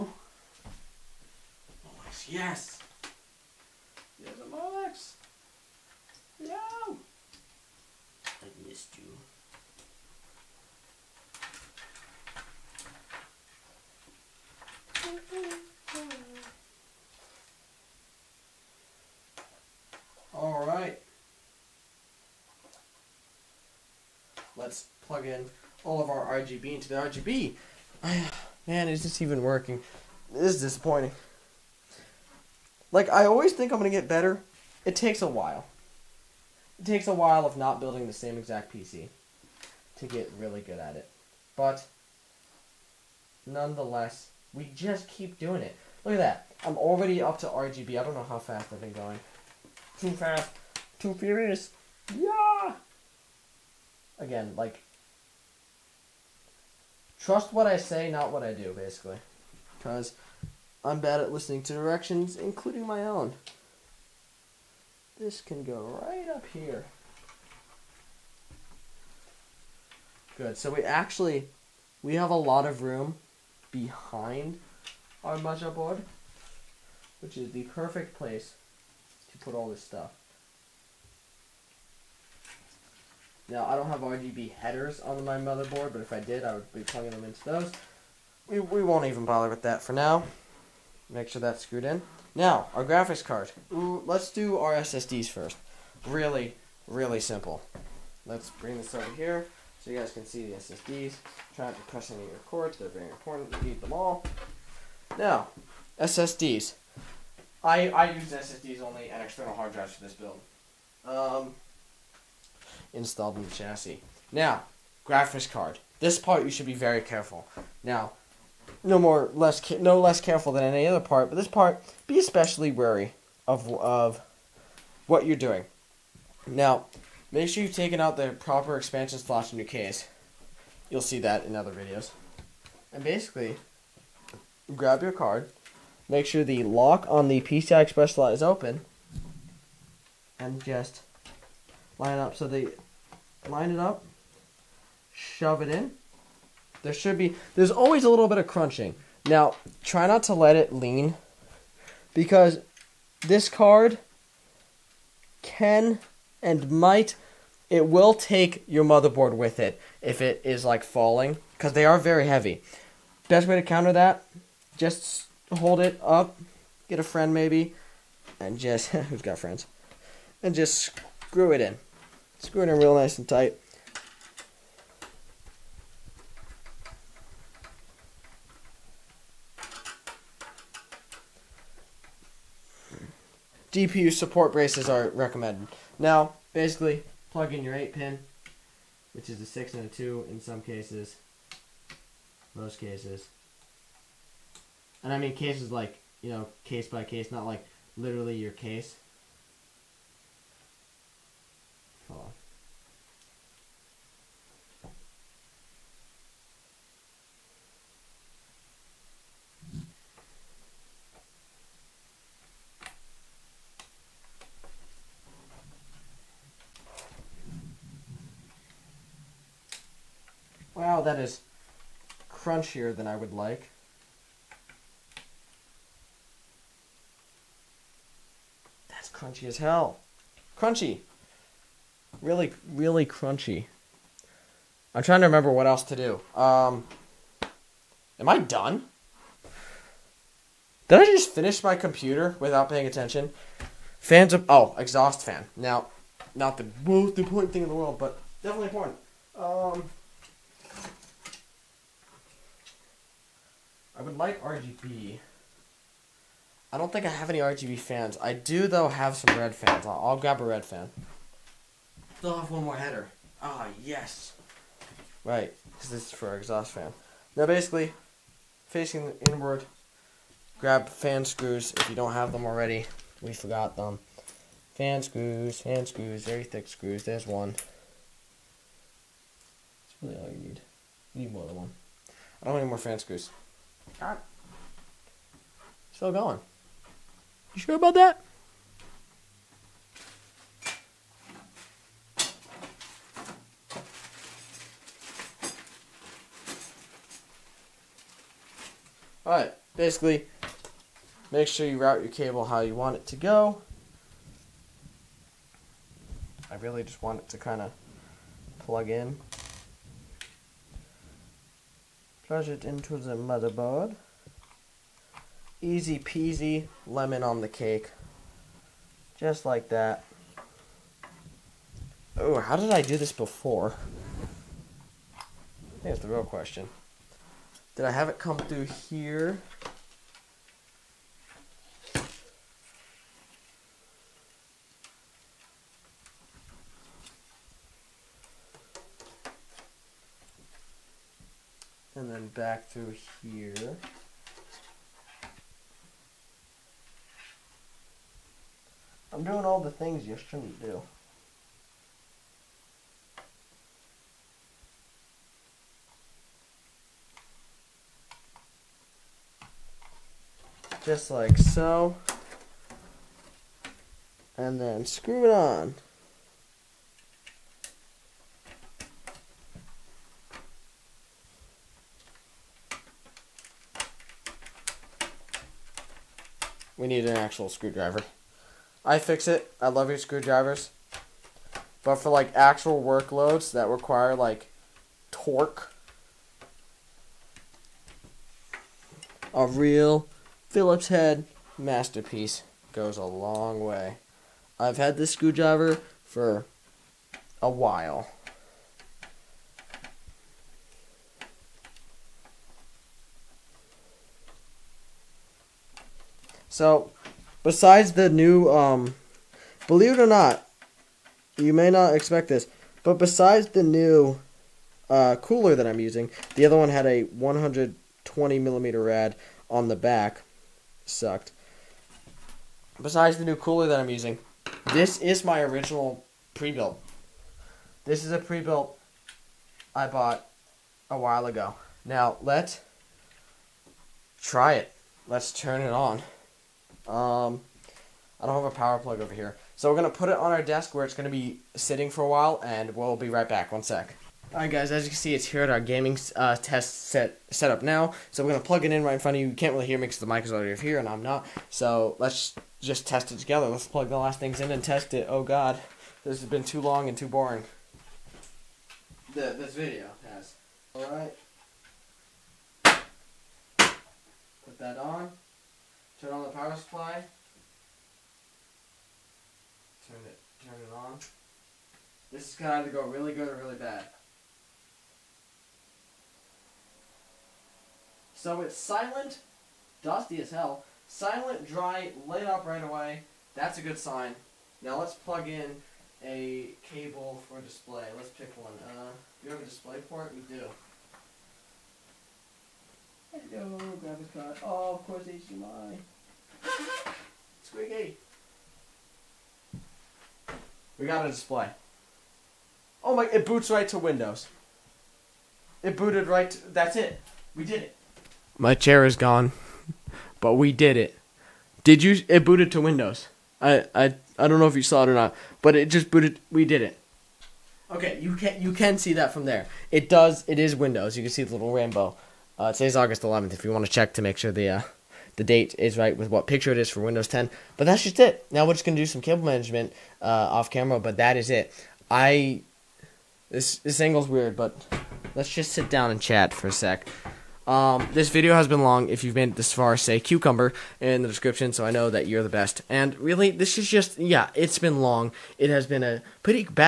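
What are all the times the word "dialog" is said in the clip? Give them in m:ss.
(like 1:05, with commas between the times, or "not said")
not said.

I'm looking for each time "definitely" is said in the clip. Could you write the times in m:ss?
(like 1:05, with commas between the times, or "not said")
4:08.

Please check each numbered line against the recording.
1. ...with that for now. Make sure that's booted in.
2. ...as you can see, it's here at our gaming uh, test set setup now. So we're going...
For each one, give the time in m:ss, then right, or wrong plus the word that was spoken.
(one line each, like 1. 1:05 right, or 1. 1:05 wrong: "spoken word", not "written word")
1. 1:29 wrong: "screwed", not "booted"
2. 7:24 right.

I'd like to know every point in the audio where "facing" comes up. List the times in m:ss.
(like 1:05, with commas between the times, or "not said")
4:28.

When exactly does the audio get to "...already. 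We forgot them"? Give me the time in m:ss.
4:32.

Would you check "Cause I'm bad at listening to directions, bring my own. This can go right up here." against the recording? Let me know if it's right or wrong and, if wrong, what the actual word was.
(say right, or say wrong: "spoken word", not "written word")
wrong: "including", not "bring".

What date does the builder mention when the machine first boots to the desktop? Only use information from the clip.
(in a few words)
August 11th.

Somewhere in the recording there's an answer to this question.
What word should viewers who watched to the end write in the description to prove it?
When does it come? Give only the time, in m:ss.
8:59.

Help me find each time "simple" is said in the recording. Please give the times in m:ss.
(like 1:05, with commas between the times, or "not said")
1:37.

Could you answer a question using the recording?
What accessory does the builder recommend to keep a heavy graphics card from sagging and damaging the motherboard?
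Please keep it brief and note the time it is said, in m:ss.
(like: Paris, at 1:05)
GPU support braces, at 3:03.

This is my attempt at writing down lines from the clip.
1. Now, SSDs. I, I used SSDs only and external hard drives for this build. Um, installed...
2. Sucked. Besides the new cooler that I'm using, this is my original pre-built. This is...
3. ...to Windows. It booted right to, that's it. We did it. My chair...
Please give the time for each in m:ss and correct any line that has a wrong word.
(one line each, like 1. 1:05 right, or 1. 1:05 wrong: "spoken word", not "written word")
1. 1:45 right
2. 7:00 right
3. 8:23 right.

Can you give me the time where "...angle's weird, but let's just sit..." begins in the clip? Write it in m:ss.
8:53.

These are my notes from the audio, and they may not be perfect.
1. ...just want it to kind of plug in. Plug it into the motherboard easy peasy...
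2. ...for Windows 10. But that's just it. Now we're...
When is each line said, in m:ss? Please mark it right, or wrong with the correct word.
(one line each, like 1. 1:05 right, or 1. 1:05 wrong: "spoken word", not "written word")
1. 5:06 right
2. 8:46 right.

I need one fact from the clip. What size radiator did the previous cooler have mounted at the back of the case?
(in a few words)
120 millimeter.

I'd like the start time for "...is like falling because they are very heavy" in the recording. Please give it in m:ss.
2:40.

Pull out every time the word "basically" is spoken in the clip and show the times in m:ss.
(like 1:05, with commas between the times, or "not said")
0:58, 2:13, 3:06, 4:27, 4:59.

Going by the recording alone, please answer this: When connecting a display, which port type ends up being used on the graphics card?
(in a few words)
HDMI.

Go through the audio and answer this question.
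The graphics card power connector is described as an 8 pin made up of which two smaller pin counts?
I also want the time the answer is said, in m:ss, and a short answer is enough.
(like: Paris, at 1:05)
6 and 2, at 3:09.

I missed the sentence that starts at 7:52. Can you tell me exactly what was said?
This is gonna either go really good or really bad.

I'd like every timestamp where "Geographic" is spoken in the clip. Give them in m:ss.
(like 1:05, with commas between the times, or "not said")
not said.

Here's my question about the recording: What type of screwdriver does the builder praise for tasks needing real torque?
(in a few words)
Phillips head.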